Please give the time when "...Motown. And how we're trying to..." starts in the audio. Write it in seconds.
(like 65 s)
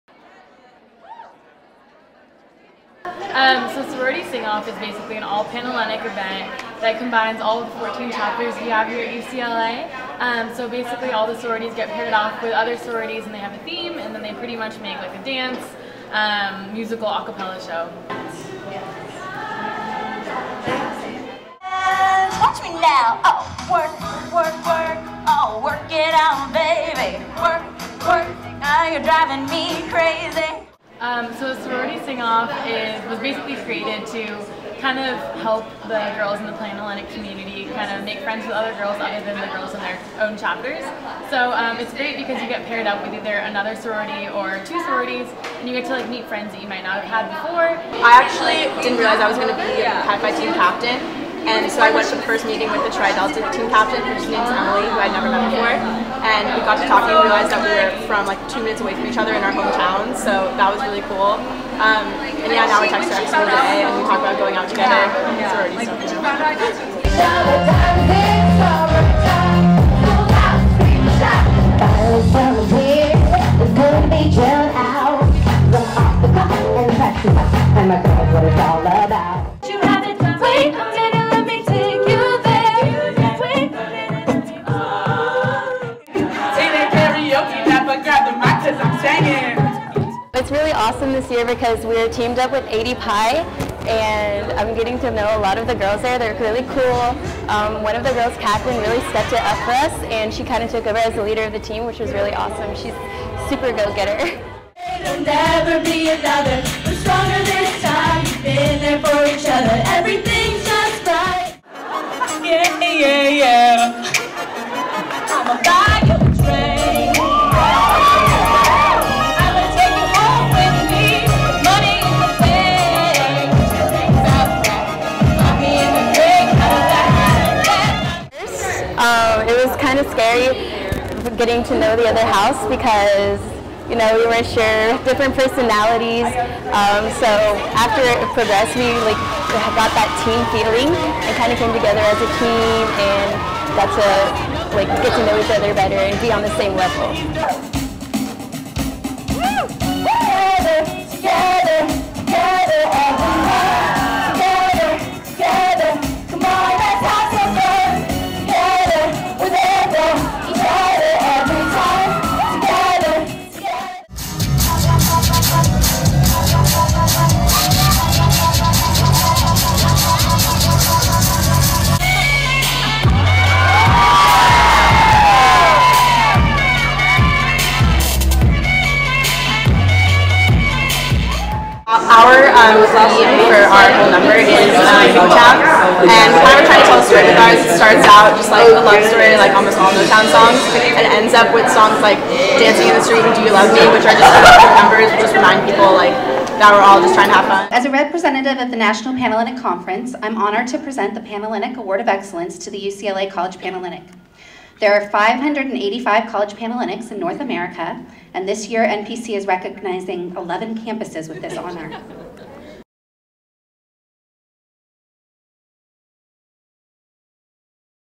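185 s.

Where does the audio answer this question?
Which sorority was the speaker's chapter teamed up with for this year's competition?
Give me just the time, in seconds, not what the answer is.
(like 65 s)
92 s.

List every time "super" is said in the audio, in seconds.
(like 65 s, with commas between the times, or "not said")
103 s.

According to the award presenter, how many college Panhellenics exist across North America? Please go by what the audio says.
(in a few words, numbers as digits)
585.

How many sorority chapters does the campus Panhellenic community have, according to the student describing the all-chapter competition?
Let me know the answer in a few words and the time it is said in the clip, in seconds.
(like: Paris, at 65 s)
14, at 7 s.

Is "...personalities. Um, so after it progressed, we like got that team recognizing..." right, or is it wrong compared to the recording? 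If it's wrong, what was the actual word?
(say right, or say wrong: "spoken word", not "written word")
wrong: "feeling", not "recognizing".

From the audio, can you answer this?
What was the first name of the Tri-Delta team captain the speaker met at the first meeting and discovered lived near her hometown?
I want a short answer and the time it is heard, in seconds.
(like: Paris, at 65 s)
Emily, at 54 s.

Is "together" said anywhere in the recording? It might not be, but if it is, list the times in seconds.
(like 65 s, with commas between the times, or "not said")
64 s, 141 s.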